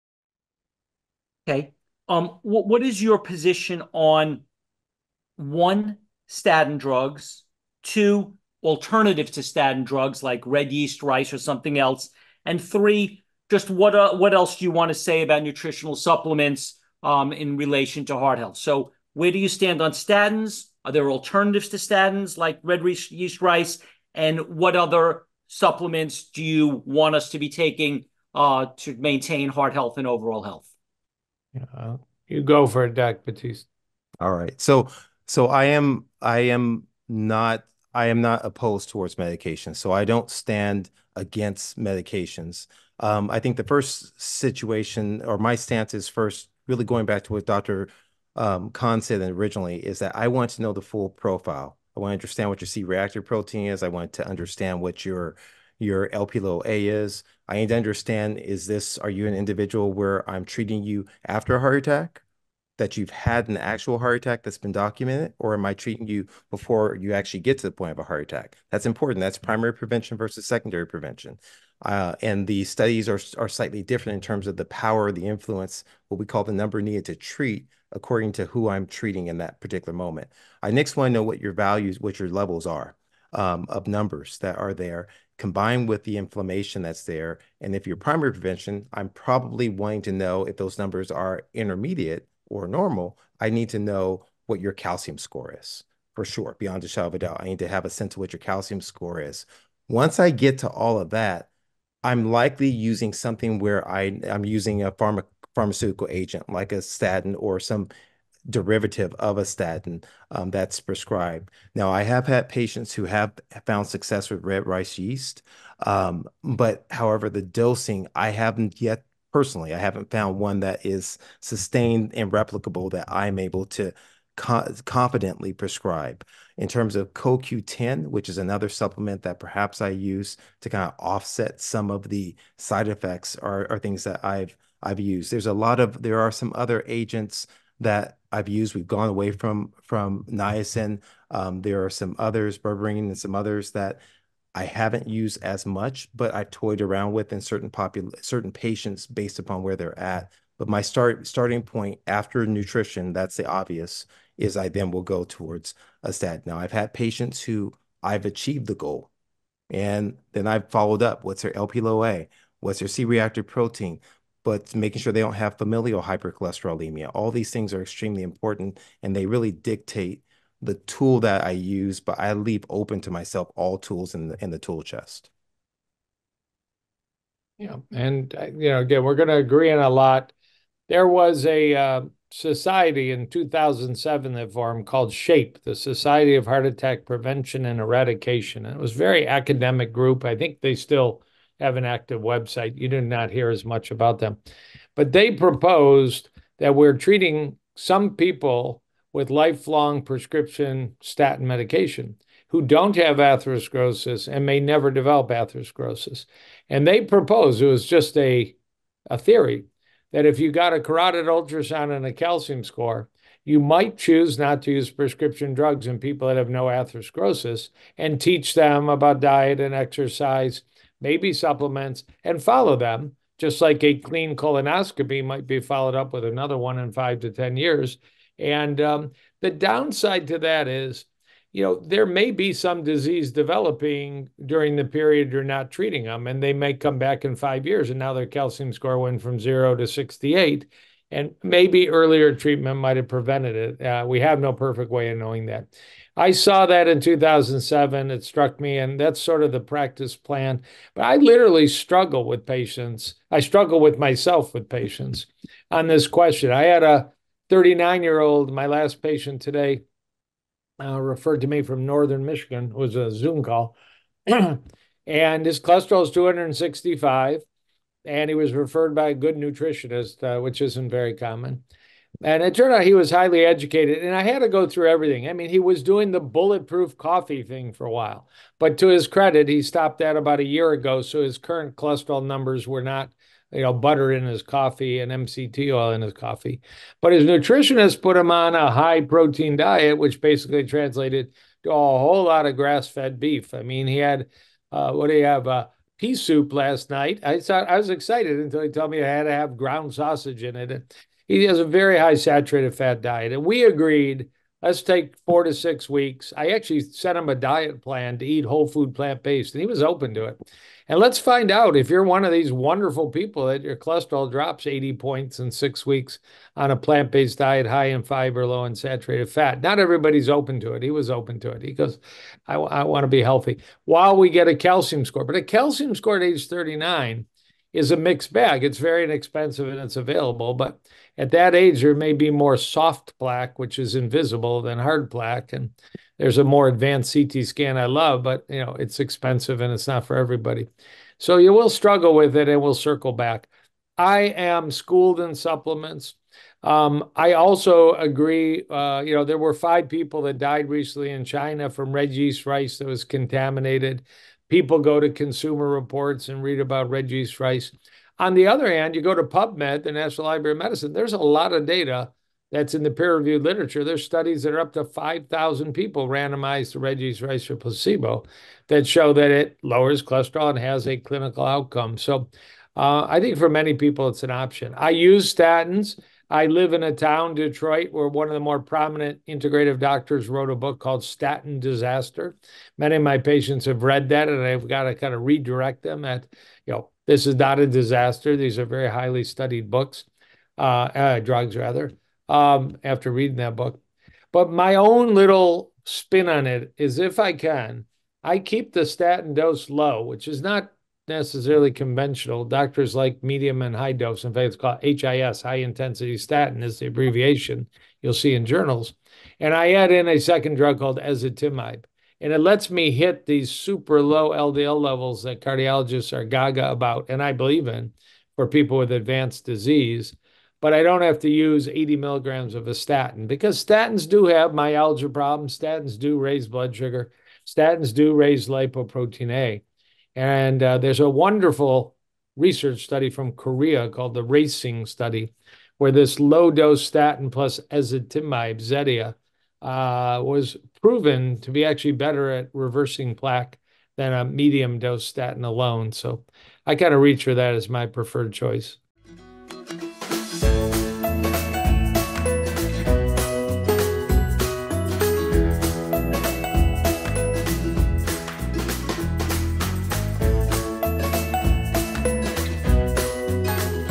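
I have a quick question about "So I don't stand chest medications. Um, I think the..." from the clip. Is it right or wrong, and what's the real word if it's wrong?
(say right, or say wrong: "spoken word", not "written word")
wrong: "against", not "chest".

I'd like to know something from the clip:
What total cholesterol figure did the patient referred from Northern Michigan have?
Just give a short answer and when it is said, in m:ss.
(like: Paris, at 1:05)
265, at 4:26.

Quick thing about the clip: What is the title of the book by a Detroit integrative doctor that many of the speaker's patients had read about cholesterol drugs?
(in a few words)
Statin Disaster.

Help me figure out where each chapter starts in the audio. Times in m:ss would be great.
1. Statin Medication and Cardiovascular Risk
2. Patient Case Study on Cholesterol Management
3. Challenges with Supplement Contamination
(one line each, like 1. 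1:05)
1. 2:56
2. 5:30
3. 5:43.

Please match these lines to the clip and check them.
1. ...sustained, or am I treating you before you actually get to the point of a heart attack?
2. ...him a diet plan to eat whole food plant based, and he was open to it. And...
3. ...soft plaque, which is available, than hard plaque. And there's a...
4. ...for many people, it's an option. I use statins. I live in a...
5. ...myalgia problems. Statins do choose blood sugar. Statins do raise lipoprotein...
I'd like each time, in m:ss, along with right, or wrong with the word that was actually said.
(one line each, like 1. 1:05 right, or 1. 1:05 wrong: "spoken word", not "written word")
1. 1:04 wrong: "documented", not "sustained"
2. 5:07 right
3. 5:32 wrong: "invisible", not "available"
4. 6:13 right
5. 7:04 wrong: "raise", not "choose".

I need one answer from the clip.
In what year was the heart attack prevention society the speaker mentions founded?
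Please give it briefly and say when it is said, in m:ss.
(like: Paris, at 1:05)
2007, at 3:03.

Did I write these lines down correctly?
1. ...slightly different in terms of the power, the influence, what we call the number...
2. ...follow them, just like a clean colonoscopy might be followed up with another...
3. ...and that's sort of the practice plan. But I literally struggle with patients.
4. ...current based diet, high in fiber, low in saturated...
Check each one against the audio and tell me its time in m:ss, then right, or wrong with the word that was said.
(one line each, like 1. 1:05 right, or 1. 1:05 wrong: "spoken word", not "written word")
1. 1:13 right
2. 3:42 right
3. 4:08 right
4. 5:16 wrong: "plant", not "current".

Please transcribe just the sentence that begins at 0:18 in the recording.
So where do you stand on statins?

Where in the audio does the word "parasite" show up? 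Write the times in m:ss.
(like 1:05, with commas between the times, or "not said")
not said.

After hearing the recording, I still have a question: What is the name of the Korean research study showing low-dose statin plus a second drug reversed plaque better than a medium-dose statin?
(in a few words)
Racing Study.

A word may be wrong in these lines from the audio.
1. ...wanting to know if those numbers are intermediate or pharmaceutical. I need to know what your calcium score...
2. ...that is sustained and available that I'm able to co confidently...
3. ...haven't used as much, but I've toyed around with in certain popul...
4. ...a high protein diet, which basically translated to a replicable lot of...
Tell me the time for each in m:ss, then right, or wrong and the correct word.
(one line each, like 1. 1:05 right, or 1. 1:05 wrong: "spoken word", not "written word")
1. 1:29 wrong: "normal", not "pharmaceutical"
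2. 2:00 wrong: "replicable", not "available"
3. 2:24 right
4. 4:48 wrong: "whole", not "replicable".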